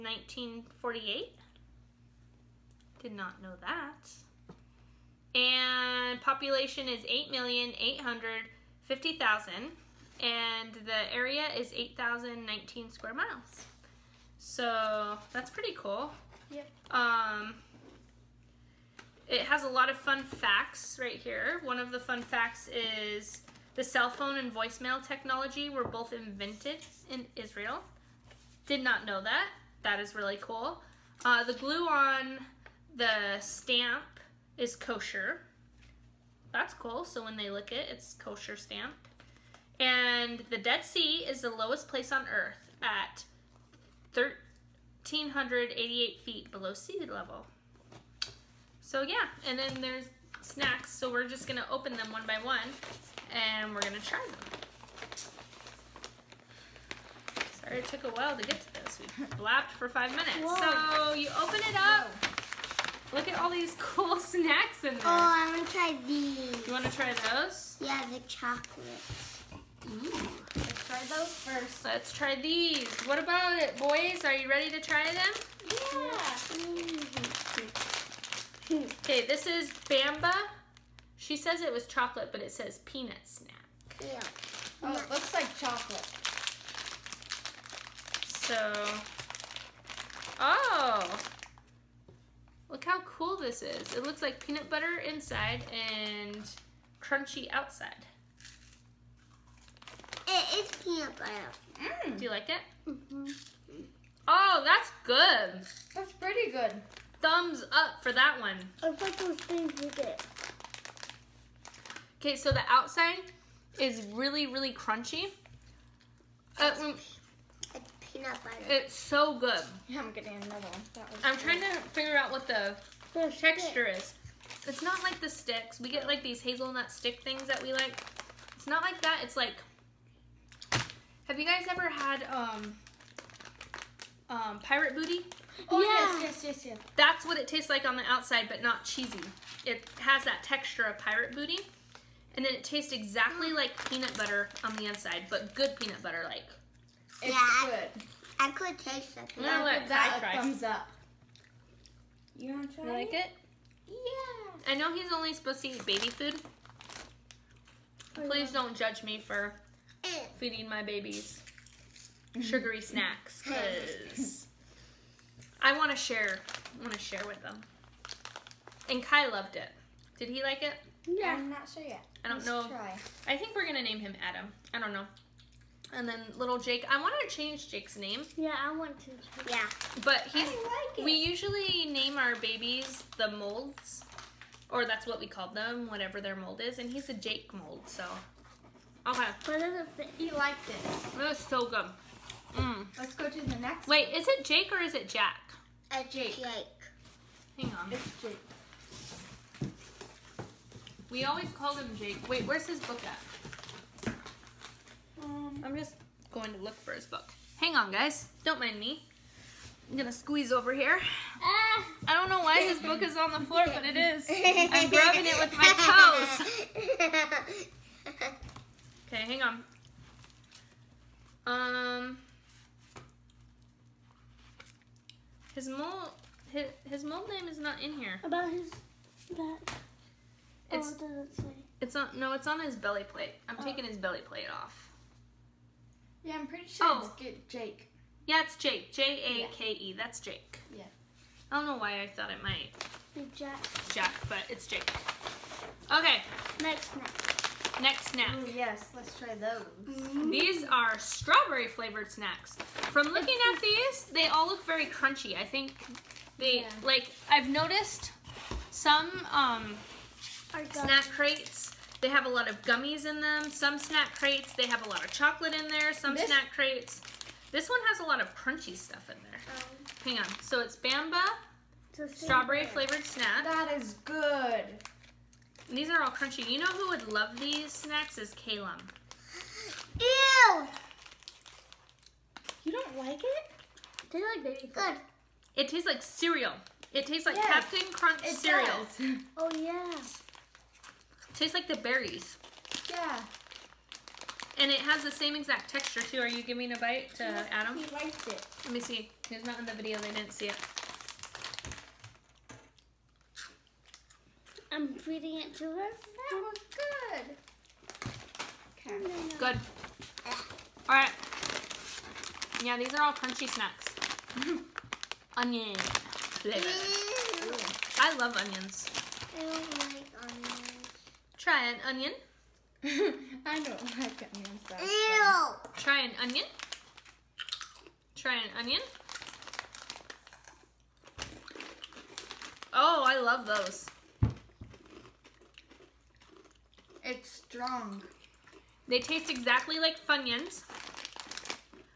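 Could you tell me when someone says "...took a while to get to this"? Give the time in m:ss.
0:57.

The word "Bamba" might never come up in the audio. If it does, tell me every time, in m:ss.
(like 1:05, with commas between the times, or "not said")
1:19, 4:30.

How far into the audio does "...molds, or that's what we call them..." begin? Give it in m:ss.
3:03.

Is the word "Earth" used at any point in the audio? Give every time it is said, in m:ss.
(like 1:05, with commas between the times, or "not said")
0:42.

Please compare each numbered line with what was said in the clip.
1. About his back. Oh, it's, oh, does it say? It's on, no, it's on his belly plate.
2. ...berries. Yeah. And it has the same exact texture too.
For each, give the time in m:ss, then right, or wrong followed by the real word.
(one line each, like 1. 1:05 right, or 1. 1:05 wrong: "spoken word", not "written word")
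1. 3:48 right
2. 4:51 right.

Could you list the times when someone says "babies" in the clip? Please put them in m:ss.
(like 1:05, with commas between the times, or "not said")
2:40, 3:02.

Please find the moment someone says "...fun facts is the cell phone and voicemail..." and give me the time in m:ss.
0:21.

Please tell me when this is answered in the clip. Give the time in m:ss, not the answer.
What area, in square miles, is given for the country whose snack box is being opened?
0:11.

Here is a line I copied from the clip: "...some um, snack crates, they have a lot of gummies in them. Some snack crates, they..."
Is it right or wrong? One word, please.
right.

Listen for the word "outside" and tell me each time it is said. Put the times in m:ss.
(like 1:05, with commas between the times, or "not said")
1:37, 1:52, 2:18.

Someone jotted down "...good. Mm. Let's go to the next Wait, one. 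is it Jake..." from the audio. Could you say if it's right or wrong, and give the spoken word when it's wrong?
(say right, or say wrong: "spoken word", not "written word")
right.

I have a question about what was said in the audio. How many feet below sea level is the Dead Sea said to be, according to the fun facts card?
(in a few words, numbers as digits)
1,388.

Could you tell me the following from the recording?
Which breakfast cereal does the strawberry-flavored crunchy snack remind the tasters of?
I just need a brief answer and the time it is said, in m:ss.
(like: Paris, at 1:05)
Captain Crunch, at 4:47.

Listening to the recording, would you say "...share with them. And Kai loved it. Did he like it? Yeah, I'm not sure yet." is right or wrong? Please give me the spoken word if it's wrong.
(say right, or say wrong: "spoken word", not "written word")
right.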